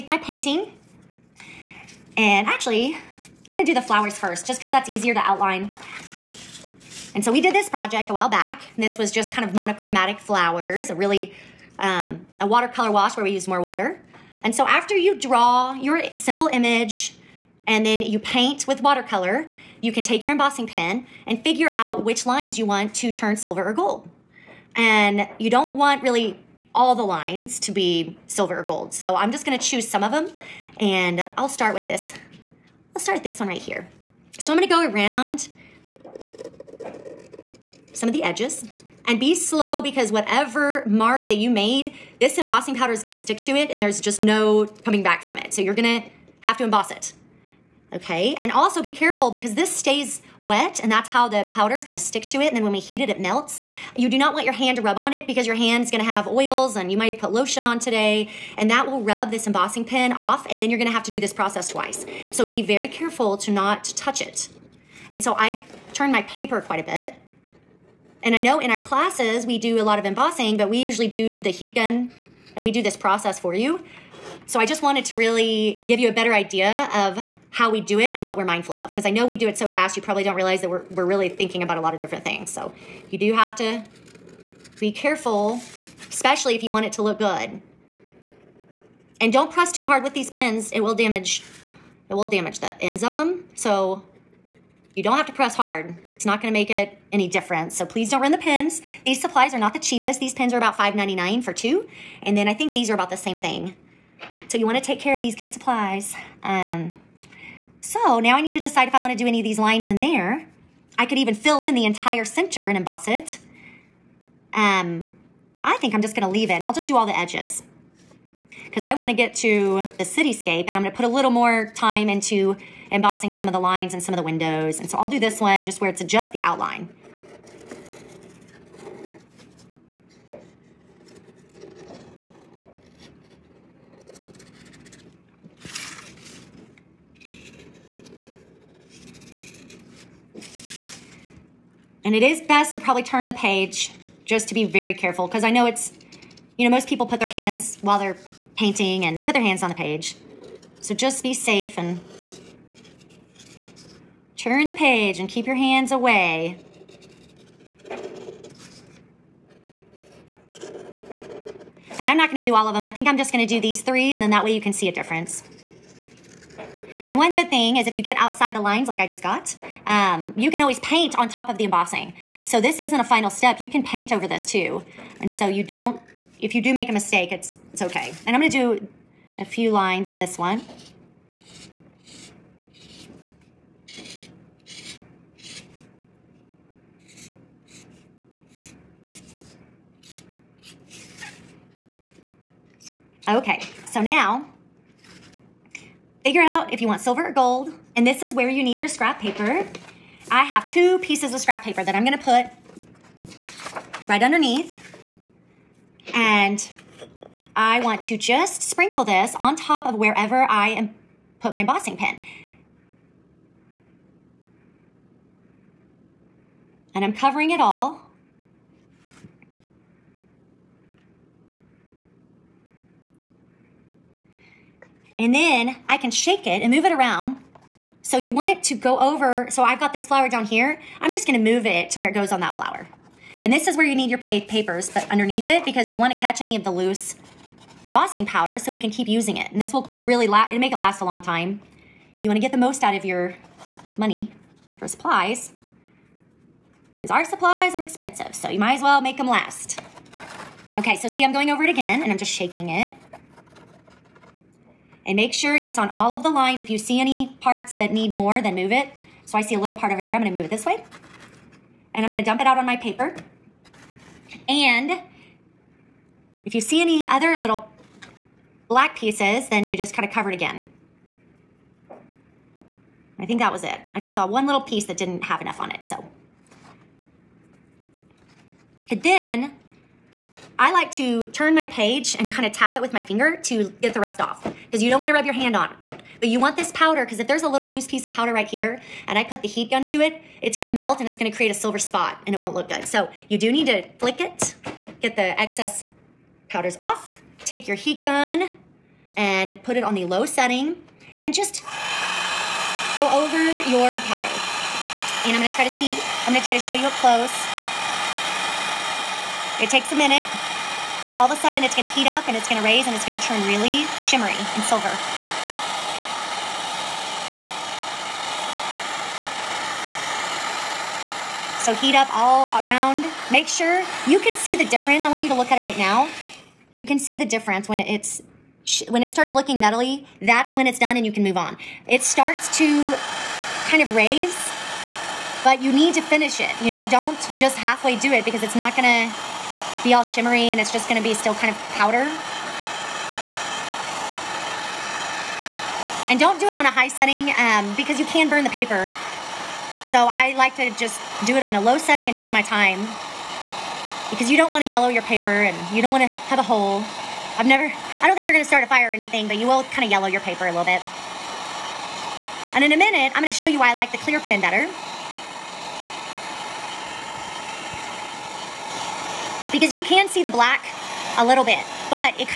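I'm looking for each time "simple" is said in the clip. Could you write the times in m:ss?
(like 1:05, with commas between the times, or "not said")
0:16.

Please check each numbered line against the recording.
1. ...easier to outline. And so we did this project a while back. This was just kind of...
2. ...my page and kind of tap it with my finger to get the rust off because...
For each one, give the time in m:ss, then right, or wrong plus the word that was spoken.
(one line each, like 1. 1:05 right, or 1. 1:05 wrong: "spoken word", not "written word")
1. 0:04 right
2. 4:41 right.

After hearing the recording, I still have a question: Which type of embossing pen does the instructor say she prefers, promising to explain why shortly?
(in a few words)
clear pen.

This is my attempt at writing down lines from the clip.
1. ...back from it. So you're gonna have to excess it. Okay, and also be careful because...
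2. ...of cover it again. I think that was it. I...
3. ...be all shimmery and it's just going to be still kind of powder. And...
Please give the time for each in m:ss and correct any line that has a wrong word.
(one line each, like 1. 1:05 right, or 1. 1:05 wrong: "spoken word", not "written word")
1. 0:45 wrong: "emboss", not "excess"
2. 4:30 right
3. 5:39 right.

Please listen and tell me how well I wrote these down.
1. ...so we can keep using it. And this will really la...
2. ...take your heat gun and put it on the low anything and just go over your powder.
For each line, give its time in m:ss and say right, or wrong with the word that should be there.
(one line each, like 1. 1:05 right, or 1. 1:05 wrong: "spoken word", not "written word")
1. 3:58 right
2. 4:57 wrong: "setting", not "anything".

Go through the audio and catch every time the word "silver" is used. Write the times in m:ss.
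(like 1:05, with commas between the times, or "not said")
0:23, 0:28, 3:16, 4:51, 5:14.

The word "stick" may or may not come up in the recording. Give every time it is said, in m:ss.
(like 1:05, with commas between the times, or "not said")
0:43, 0:51.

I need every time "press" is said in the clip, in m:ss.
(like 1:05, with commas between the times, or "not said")
1:29, 1:35.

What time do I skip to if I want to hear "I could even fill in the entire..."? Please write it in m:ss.
1:50.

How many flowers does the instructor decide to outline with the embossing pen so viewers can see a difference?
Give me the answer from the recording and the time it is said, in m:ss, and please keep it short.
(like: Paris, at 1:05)
3, at 2:43.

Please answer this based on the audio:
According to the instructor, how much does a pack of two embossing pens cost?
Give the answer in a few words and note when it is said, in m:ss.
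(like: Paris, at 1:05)
$5.99, at 1:40.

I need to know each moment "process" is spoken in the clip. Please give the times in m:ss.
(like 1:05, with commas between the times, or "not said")
1:01, 1:12.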